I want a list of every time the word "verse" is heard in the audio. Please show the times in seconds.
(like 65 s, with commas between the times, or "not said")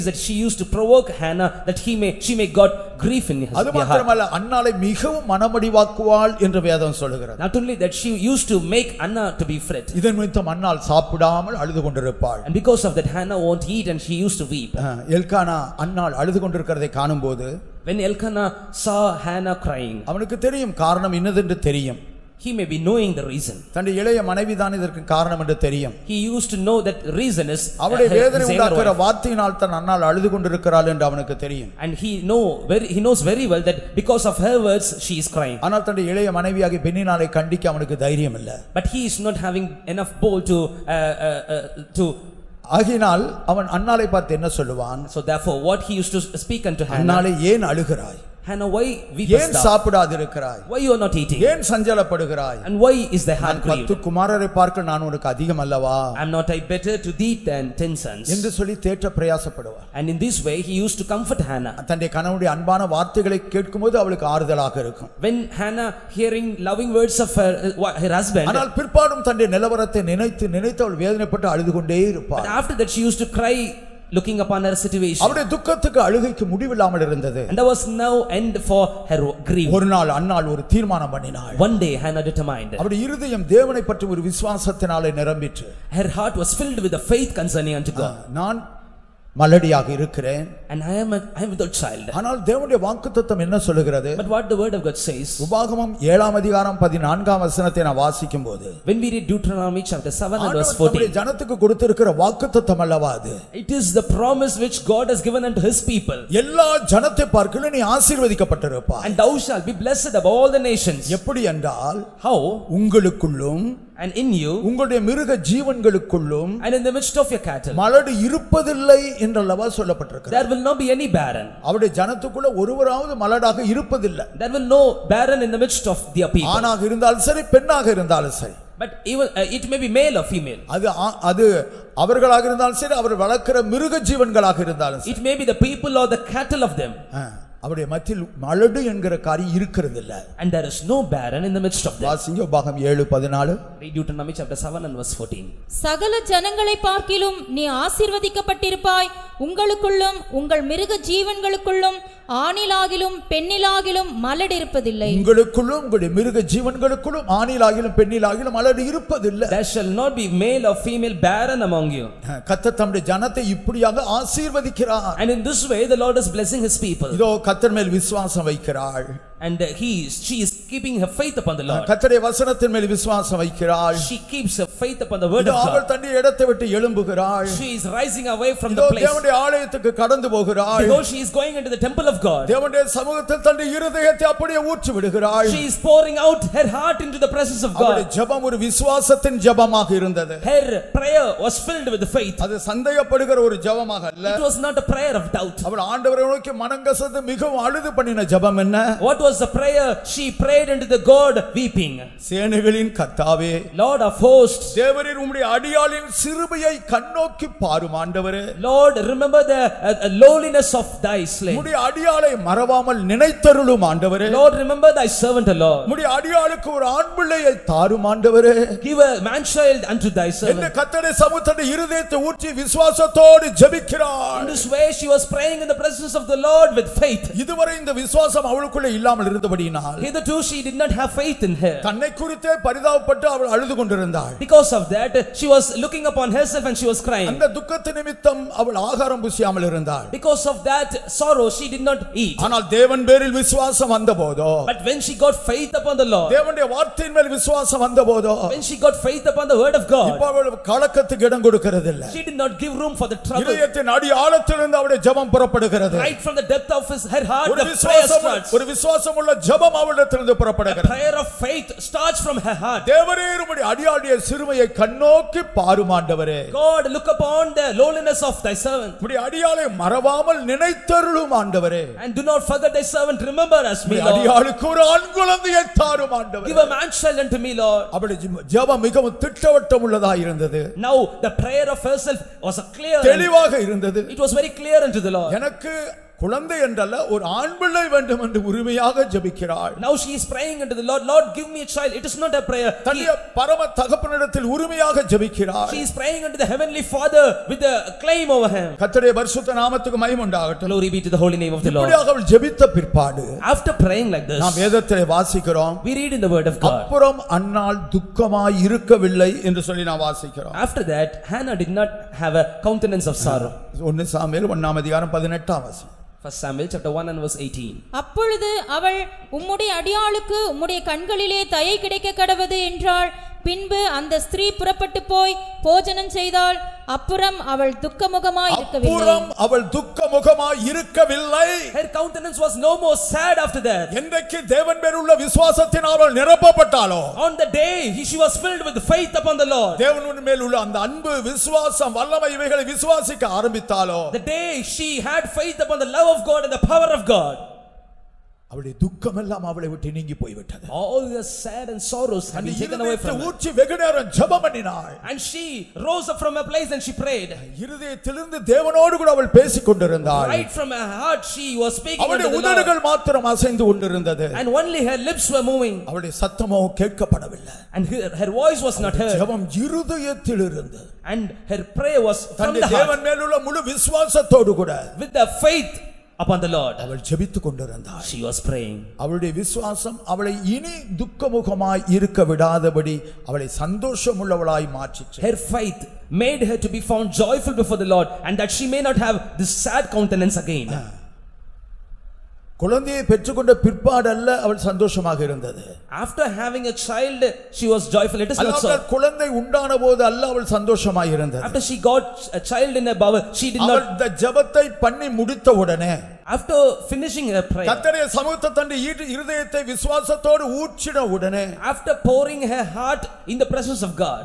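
100 s, 145 s.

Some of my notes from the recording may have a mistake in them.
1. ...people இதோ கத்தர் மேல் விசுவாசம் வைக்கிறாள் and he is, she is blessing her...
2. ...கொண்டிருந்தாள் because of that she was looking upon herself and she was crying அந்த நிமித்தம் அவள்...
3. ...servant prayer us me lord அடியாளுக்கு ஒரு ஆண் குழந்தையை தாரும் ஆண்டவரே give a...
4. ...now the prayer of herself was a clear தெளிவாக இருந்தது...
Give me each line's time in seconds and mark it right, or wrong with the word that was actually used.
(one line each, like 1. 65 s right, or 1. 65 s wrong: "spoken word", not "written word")
1. 166 s wrong: "keeping", not "blessing"
2. 233 s right
3. 272 s wrong: "remember", not "prayer"
4. 280 s right.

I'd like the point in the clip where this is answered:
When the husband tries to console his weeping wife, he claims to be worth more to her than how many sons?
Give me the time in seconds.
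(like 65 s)
57 s.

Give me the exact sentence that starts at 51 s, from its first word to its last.
ஏன் சஞ்சலப்படுகிறாய் And why is the heart grieved?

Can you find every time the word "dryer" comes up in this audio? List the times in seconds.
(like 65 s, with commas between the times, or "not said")
not said.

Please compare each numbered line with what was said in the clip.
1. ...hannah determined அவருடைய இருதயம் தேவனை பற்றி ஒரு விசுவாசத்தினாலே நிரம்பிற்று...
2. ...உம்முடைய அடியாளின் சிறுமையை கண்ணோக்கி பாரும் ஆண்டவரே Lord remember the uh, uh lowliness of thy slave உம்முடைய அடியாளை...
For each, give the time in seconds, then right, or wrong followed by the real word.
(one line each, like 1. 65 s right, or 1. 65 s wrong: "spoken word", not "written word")
1. 82 s right
2. 205 s right.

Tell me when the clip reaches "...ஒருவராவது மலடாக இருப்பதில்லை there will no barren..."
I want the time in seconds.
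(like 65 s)
122 s.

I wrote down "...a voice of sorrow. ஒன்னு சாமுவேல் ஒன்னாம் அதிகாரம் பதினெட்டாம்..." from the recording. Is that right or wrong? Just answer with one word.
wrong.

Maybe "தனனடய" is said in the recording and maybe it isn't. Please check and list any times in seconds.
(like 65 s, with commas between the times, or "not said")
23 s, 35 s, 61 s, 69 s, 175 s, 183 s, 292 s.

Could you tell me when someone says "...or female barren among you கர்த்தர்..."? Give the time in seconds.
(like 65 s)
160 s.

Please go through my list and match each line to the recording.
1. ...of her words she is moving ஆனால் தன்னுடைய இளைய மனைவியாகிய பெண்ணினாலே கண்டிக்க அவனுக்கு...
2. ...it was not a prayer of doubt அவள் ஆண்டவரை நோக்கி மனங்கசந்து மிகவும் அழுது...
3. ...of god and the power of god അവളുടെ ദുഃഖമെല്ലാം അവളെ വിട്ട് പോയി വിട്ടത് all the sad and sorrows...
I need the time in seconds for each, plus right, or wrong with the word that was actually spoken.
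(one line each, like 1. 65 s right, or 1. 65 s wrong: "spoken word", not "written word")
1. 34 s wrong: "crying", not "moving"
2. 194 s right
3. 346 s right.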